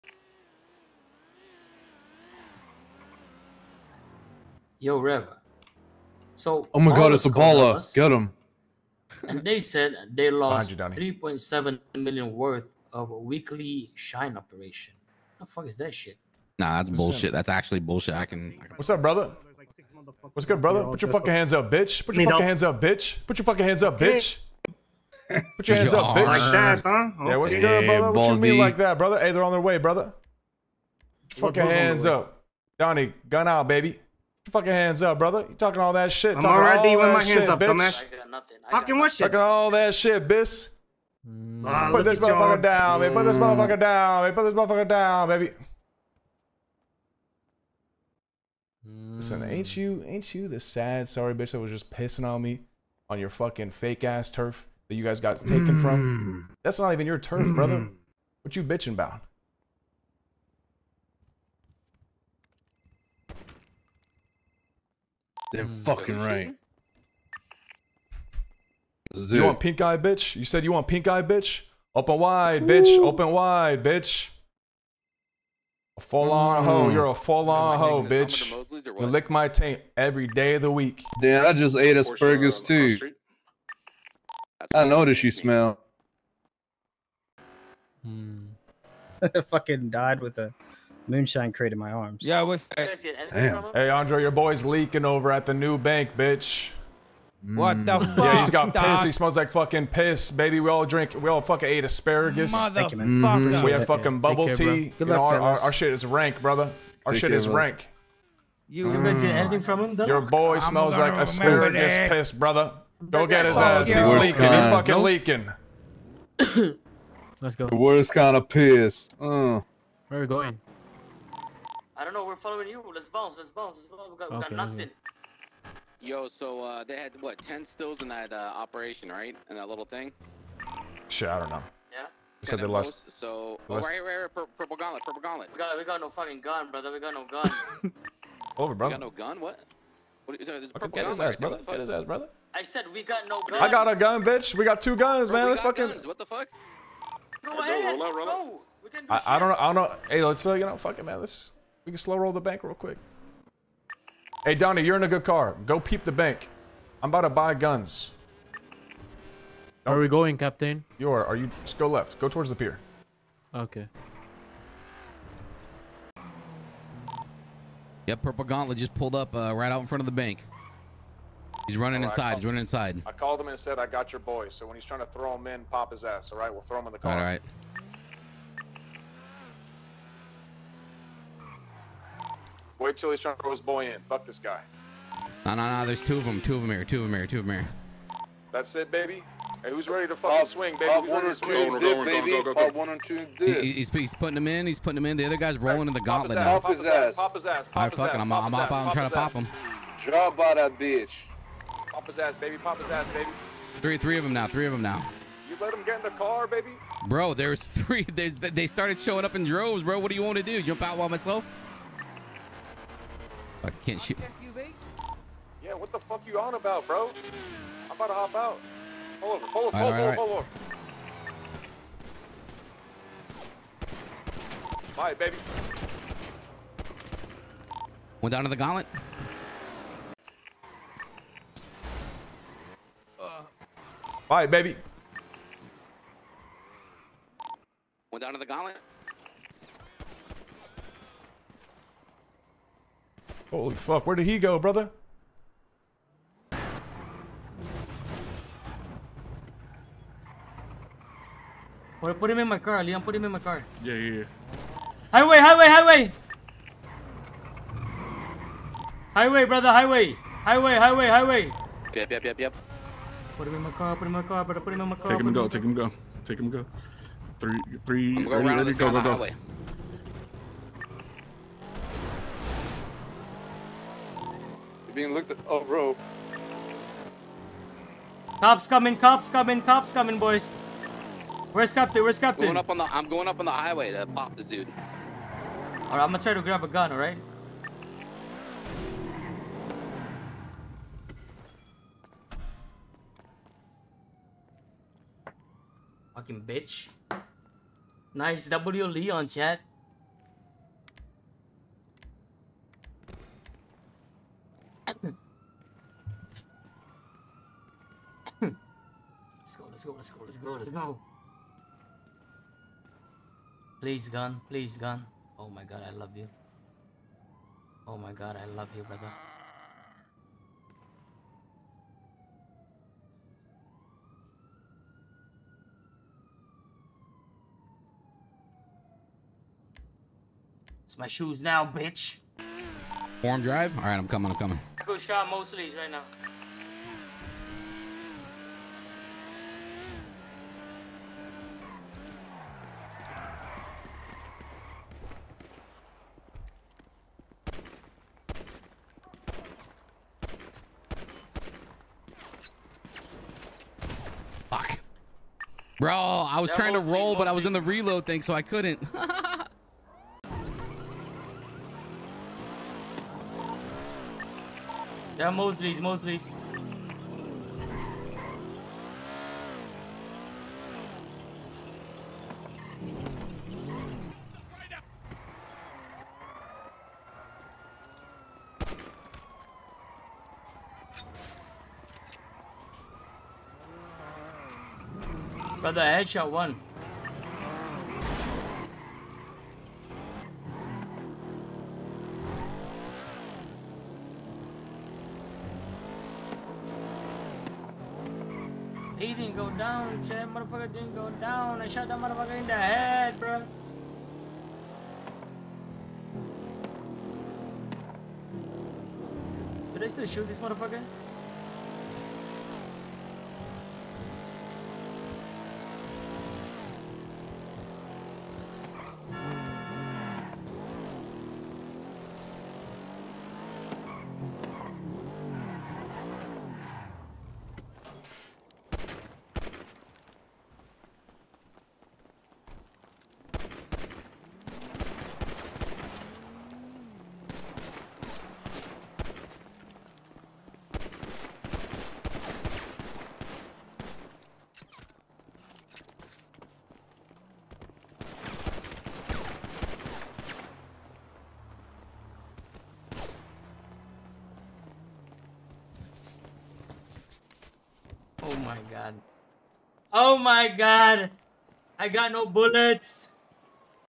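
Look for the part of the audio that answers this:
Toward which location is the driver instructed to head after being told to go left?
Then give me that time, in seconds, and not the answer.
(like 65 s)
162 s.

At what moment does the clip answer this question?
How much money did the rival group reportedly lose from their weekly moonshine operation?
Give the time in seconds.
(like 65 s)
10 s.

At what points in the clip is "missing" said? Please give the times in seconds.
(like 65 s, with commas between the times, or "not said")
109 s.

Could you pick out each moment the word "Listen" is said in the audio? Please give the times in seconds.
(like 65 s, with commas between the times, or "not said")
49 s.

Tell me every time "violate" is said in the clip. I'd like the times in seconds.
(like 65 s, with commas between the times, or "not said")
not said.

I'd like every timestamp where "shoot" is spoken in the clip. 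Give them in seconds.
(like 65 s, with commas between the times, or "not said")
214 s, 410 s.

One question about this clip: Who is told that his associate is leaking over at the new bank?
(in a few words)
Andre.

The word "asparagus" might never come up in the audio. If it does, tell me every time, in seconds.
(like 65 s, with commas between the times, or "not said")
81 s, 101 s, 111 s.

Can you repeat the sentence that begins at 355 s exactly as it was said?
Bro, I was that trying to roll, but I was in the reload thing, so I couldn't.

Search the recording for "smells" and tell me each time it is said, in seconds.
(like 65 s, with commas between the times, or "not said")
85 s, 99 s, 110 s.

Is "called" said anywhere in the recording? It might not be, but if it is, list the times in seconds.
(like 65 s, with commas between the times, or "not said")
173 s.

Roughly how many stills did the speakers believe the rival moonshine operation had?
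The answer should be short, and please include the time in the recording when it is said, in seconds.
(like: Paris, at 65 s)
10, at 127 s.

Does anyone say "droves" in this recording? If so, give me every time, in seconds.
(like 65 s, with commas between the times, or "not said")
209 s.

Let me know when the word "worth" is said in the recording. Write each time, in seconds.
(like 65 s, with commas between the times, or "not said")
12 s.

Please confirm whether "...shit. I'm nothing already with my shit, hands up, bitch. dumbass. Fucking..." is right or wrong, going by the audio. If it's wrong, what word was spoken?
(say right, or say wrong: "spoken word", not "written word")
wrong: "talking", not "nothing".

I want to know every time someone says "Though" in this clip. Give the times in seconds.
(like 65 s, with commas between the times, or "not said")
109 s.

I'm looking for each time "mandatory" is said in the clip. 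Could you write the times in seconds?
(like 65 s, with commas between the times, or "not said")
not said.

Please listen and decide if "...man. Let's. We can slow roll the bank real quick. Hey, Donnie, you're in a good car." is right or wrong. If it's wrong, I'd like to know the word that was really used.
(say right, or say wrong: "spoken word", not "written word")
right.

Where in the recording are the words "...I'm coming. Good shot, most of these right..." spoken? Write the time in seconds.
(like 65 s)
334 s.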